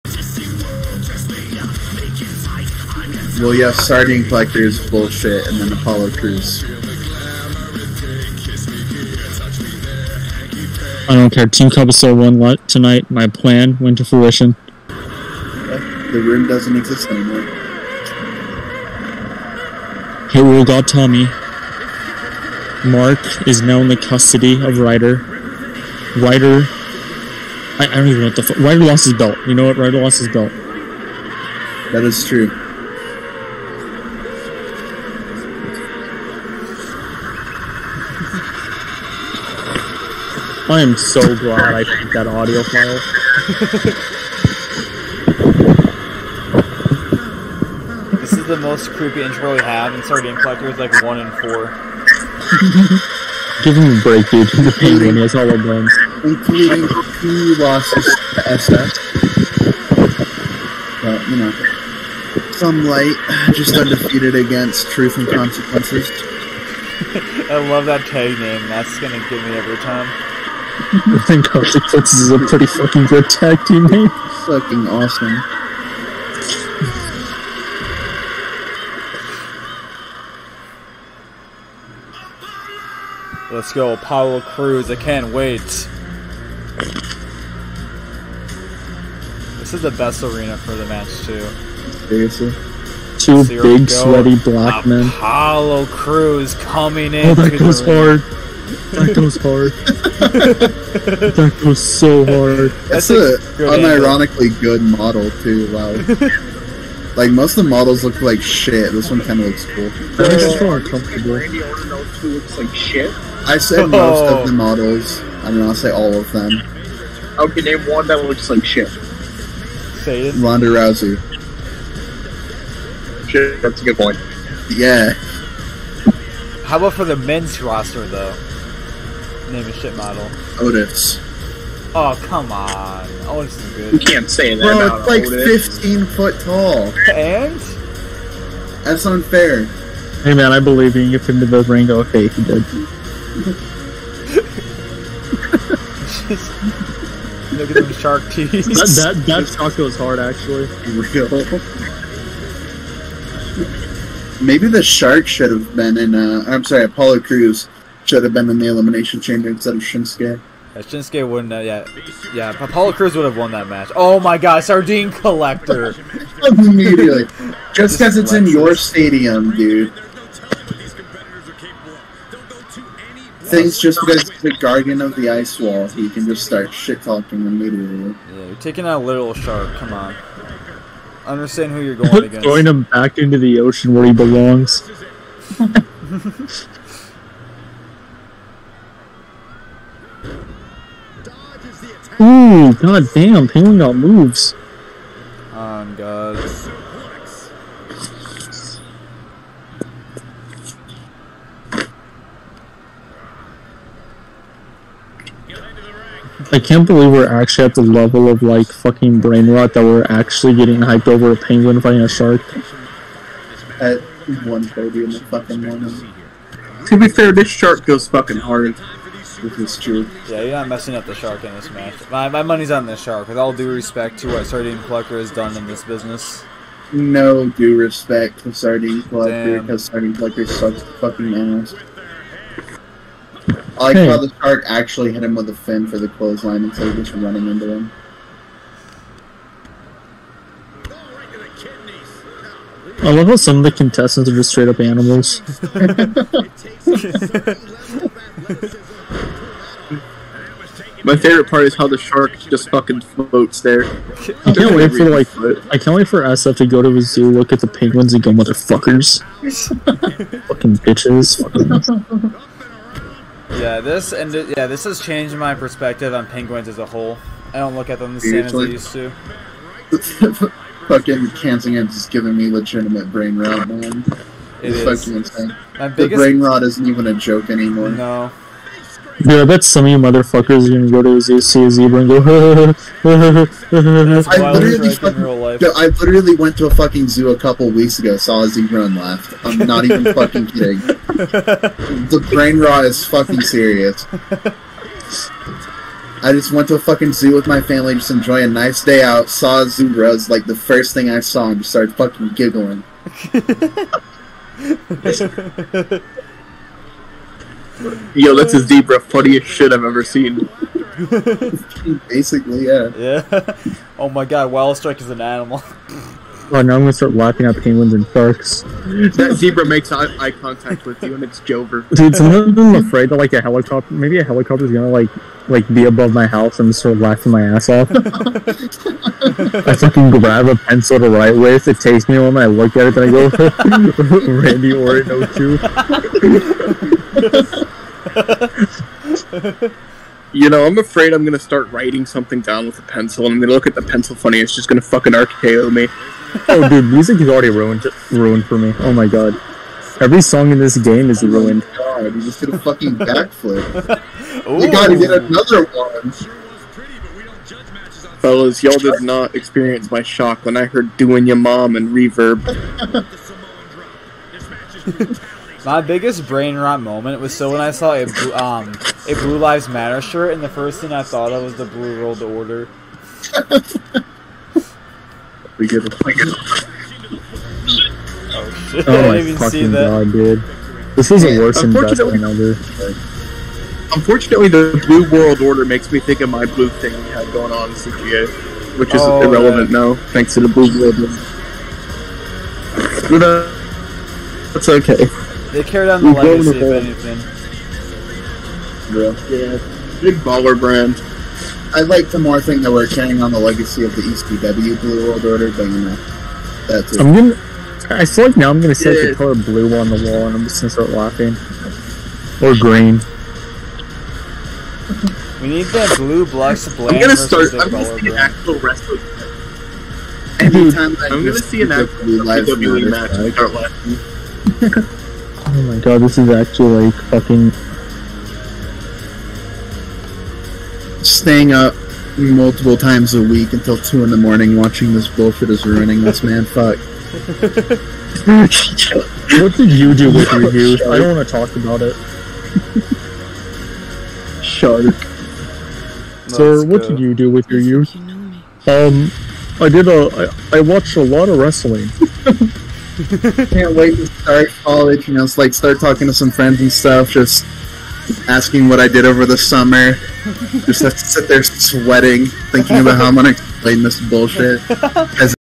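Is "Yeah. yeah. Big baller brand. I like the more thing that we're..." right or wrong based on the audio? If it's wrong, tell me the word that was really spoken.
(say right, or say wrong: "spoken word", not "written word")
right.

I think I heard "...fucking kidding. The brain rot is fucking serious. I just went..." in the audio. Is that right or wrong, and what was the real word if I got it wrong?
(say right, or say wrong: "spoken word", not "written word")
right.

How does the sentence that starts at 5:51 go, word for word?
Oh god, you just did a fucking backflip.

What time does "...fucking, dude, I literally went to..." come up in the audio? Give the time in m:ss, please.
4:44.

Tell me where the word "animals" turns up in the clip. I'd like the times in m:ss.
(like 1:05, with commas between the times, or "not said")
4:04, 5:15.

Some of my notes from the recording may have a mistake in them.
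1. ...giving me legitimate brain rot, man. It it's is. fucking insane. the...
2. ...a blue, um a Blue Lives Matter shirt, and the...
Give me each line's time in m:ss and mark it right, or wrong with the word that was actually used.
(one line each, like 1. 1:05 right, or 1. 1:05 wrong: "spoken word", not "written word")
1. 4:32 right
2. 6:07 right.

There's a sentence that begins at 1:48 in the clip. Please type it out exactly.
This one kind of looks cool.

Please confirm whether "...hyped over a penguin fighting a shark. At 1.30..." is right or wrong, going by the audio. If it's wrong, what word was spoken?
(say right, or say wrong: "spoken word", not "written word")
right.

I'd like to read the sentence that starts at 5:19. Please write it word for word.
That zebra makes eye, eye contact with you, and it's Jover.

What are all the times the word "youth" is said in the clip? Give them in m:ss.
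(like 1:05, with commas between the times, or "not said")
7:20, 7:27.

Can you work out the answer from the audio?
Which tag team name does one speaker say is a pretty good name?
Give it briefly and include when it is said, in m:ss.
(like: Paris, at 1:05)
Harley Fitz, at 1:11.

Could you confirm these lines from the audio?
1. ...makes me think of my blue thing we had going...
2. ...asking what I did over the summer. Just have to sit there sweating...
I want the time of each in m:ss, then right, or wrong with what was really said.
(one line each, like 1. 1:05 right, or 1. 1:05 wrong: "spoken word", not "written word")
1. 6:25 right
2. 7:38 right.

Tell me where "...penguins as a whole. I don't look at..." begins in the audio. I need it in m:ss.
4:26.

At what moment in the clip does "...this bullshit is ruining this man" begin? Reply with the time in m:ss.
7:14.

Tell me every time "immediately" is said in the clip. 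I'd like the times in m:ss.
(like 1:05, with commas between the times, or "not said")
2:46, 2:57.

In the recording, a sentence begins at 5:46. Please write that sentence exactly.
oh, dude, music is already ruined, ruined for me.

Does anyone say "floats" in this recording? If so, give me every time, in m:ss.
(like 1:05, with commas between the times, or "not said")
4:13.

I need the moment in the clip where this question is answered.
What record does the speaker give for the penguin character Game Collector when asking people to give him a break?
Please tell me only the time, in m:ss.
0:51.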